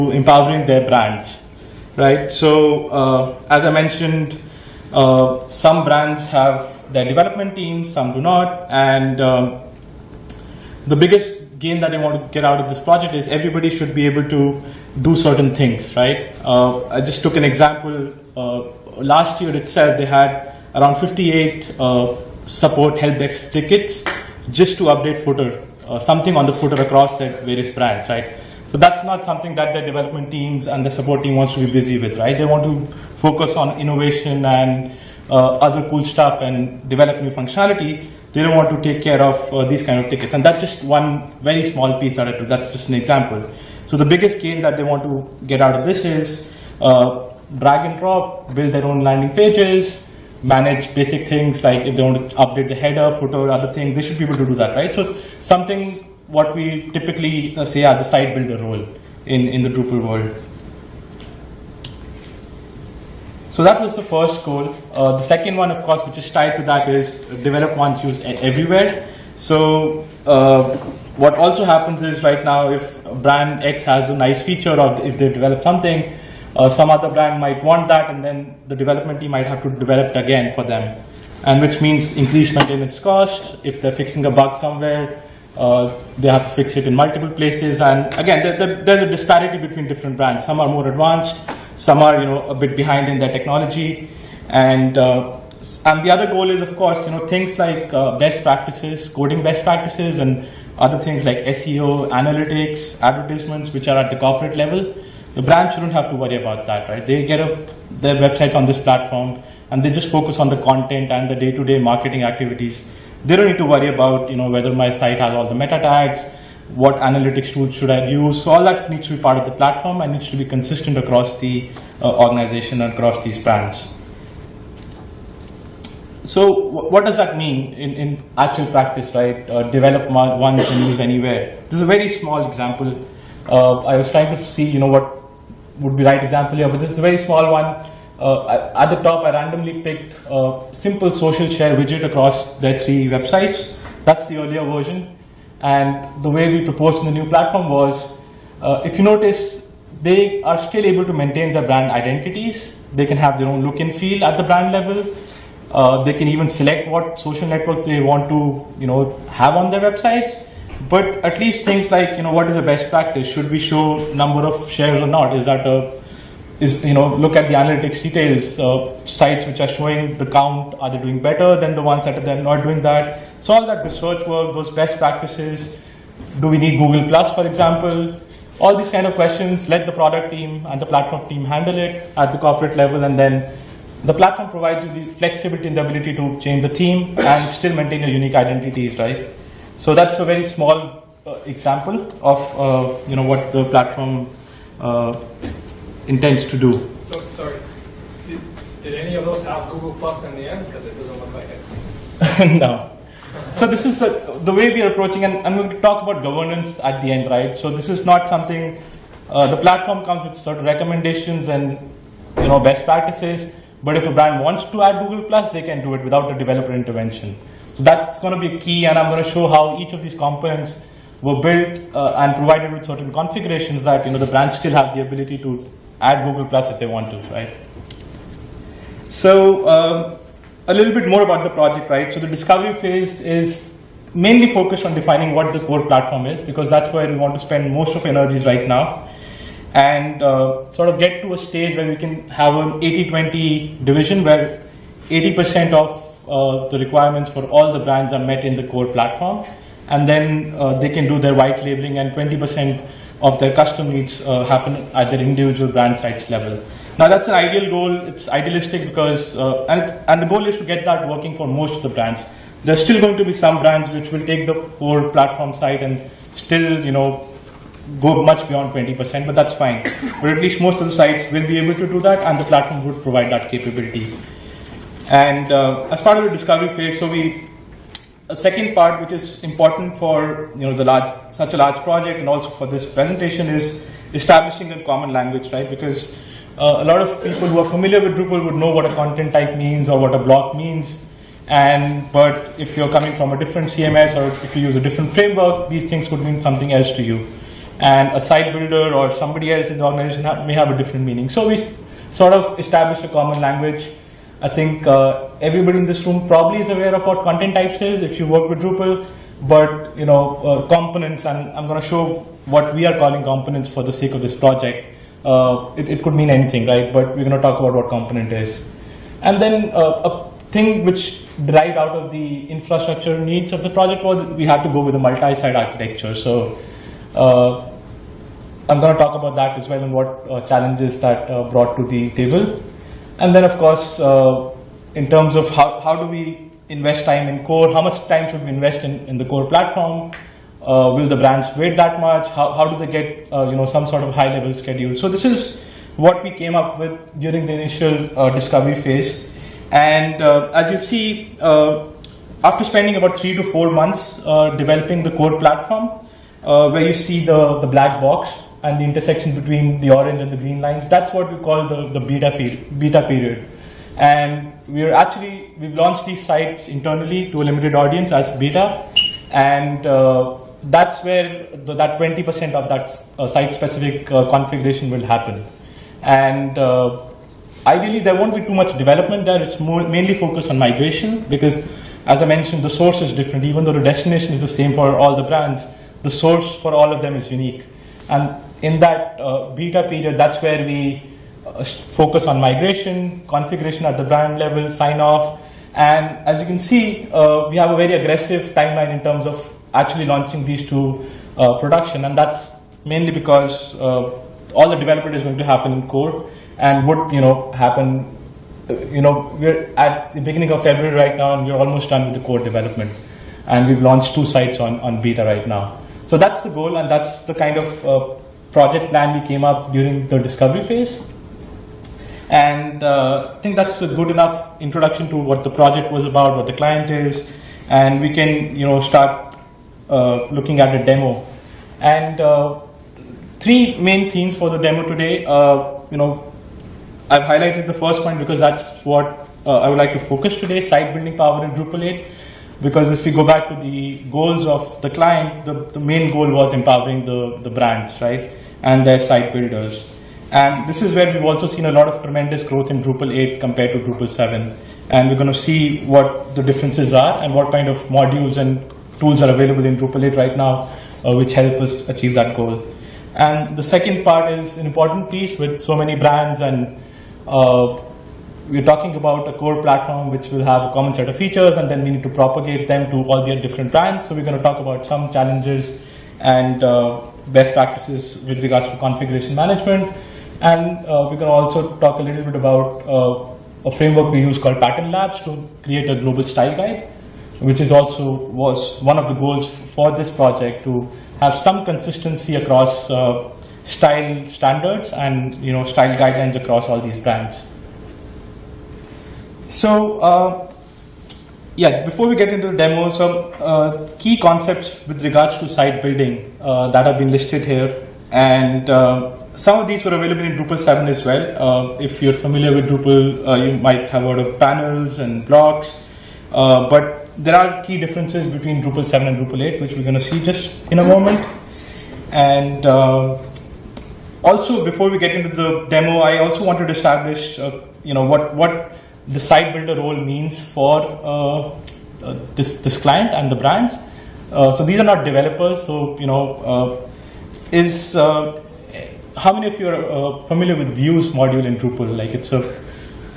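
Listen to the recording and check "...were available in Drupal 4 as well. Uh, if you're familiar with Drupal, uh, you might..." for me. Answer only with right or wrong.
wrong.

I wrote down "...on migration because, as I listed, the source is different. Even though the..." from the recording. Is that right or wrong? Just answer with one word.
wrong.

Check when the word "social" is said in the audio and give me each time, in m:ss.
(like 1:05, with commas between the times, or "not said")
2:21, 2:37.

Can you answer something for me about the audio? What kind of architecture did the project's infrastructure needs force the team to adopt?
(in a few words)
Multi-site.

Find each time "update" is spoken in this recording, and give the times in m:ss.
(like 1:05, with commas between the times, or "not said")
0:24, 0:52.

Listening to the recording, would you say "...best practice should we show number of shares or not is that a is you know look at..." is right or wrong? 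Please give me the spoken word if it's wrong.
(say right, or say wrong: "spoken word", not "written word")
right.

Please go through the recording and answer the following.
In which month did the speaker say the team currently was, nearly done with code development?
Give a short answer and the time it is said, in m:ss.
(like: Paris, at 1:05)
February, at 6:50.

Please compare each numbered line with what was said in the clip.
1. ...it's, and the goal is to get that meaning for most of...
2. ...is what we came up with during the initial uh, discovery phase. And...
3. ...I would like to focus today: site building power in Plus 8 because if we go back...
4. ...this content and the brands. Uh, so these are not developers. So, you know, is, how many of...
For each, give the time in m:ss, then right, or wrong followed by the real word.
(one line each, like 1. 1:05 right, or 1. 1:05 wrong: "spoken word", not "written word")
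1. 4:19 wrong: "working", not "meaning"
2. 5:45 right
3. 7:19 wrong: "Drupal", not "Plus"
4. 8:52 wrong: "client", not "content".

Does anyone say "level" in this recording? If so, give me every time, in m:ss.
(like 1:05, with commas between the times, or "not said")
1:44, 2:34, 3:02, 4:16, 5:44, 6:34.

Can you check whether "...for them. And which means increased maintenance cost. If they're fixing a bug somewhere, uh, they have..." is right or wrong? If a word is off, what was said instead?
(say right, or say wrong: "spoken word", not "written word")
right.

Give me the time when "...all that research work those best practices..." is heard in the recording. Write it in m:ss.
2:53.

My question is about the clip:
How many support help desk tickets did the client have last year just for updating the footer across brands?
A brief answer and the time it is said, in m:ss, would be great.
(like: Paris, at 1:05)
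58, at 0:20.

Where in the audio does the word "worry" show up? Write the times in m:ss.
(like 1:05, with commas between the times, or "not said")
1:46, 1:53.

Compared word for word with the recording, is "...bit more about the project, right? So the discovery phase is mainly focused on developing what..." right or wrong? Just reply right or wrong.
wrong.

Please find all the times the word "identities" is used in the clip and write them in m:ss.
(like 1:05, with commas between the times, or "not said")
2:31, 3:08.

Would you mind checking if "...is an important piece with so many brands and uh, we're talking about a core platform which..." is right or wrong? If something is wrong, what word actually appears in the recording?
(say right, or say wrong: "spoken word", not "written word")
right.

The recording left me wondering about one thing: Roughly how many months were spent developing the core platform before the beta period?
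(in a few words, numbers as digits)
3 to 4 months.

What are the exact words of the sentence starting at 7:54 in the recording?
So we're going to talk about some challenges and uh, best practices with regards to configuration management.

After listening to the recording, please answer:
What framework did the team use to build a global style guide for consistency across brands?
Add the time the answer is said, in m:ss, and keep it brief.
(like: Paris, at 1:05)
Pattern Labs, at 8:04.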